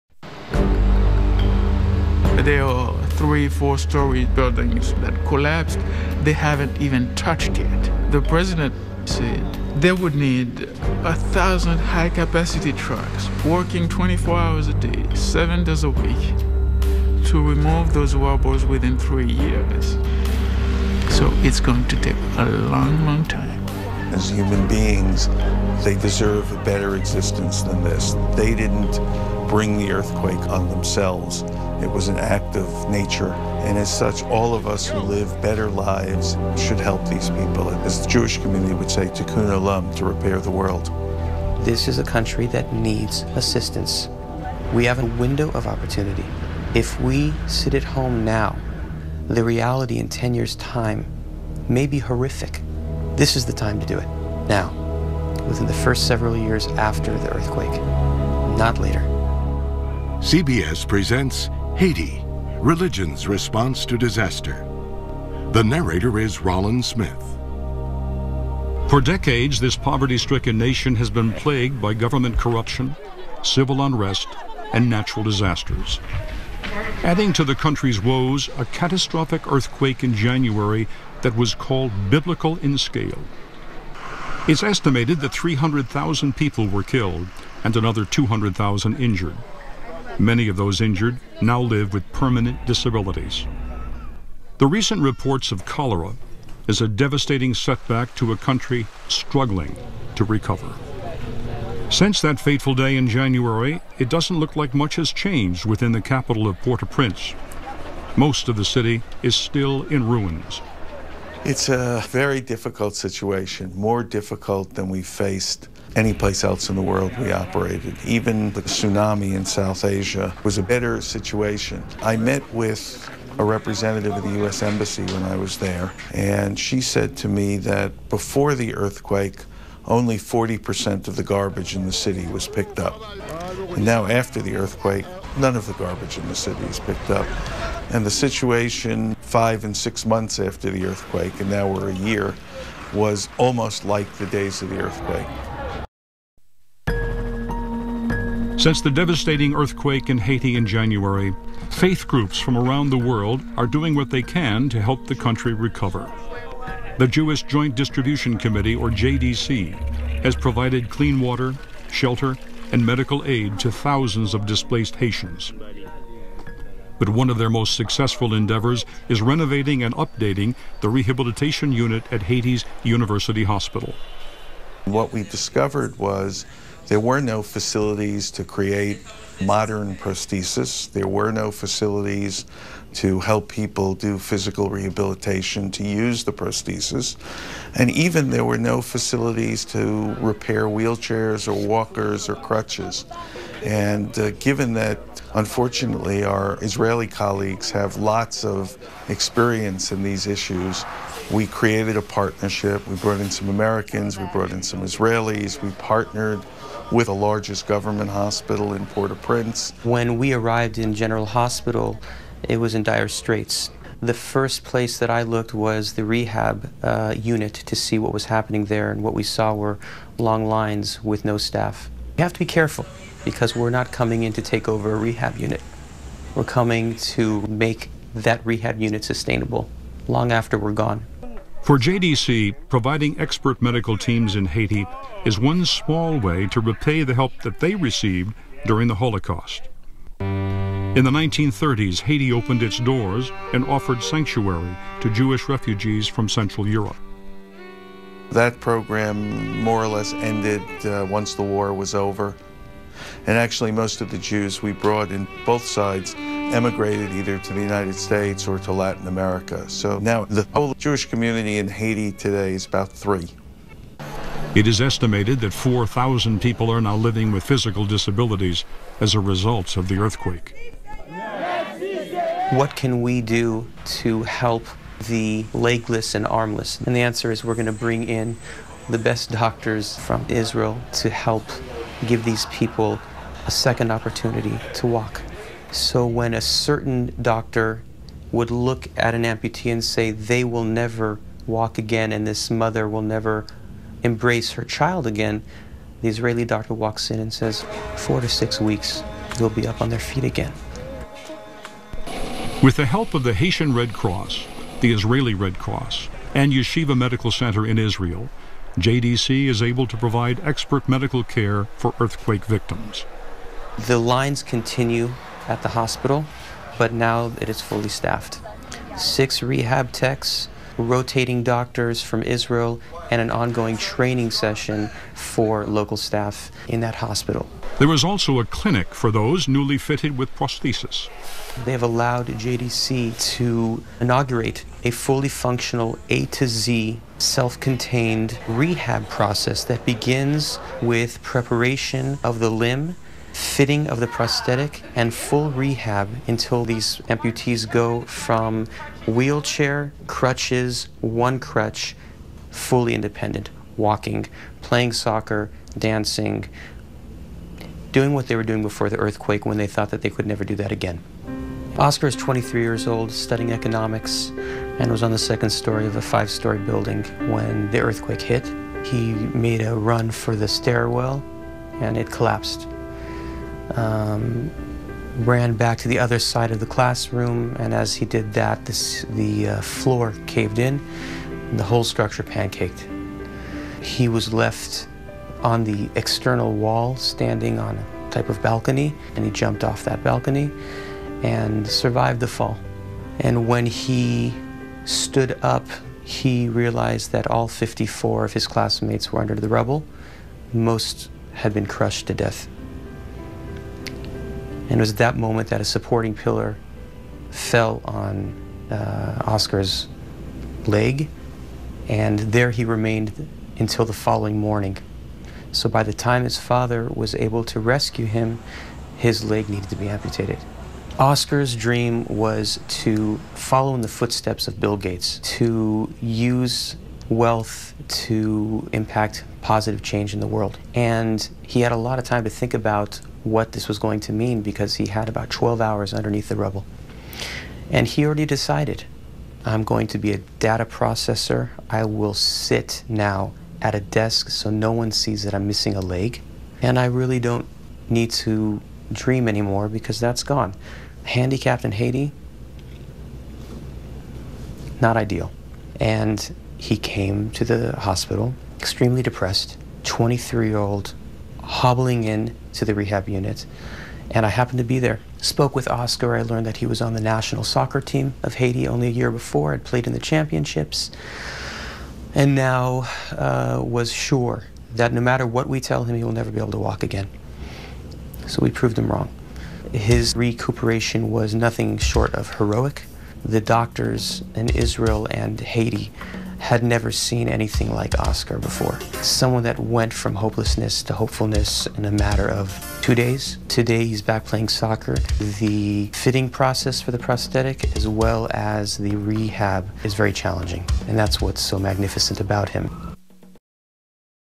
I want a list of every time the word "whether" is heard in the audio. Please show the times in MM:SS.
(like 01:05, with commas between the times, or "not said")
not said.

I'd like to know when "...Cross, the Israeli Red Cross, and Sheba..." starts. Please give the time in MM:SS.
05:03.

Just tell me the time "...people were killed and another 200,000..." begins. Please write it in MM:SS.
01:26.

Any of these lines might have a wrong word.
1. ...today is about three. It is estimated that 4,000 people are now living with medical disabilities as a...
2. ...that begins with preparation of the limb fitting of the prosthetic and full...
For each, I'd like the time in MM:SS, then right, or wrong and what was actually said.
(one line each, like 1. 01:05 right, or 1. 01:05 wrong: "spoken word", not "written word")
1. 04:22 wrong: "physical", not "medical"
2. 05:39 right.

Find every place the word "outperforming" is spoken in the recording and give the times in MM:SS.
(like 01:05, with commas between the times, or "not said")
not said.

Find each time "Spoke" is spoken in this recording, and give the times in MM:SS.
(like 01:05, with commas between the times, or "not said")
07:45.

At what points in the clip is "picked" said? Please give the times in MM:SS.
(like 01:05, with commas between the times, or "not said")
02:12, 02:16.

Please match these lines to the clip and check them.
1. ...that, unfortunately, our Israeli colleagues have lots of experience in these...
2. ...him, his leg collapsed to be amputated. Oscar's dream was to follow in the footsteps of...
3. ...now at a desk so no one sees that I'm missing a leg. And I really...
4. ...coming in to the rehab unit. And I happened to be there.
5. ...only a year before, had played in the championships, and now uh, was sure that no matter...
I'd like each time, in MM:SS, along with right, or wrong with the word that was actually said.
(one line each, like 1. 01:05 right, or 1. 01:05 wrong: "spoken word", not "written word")
1. 03:14 right
2. 06:58 wrong: "needed", not "collapsed"
3. 07:22 right
4. 07:41 wrong: "hobbling", not "coming"
5. 07:48 right.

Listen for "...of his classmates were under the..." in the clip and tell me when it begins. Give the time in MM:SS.
06:38.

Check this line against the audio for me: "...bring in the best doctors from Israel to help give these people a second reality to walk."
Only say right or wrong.
wrong.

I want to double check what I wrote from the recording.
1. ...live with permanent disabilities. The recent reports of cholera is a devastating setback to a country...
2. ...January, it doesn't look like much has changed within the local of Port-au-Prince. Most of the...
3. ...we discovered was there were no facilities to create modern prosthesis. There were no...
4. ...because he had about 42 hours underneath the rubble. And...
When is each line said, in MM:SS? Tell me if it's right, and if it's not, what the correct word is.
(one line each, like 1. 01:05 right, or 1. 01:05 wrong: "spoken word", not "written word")
1. 01:31 right
2. 01:43 wrong: "capital", not "local"
3. 02:55 right
4. 07:14 wrong: "12", not "42".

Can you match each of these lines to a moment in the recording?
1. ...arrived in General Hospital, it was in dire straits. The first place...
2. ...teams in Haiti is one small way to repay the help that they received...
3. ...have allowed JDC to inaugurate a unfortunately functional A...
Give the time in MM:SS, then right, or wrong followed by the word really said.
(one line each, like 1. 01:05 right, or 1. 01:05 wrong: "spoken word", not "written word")
1. 03:30 right
2. 03:53 right
3. 05:31 wrong: "fully", not "unfortunately".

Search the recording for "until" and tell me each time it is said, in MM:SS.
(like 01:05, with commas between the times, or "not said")
05:46, 06:53.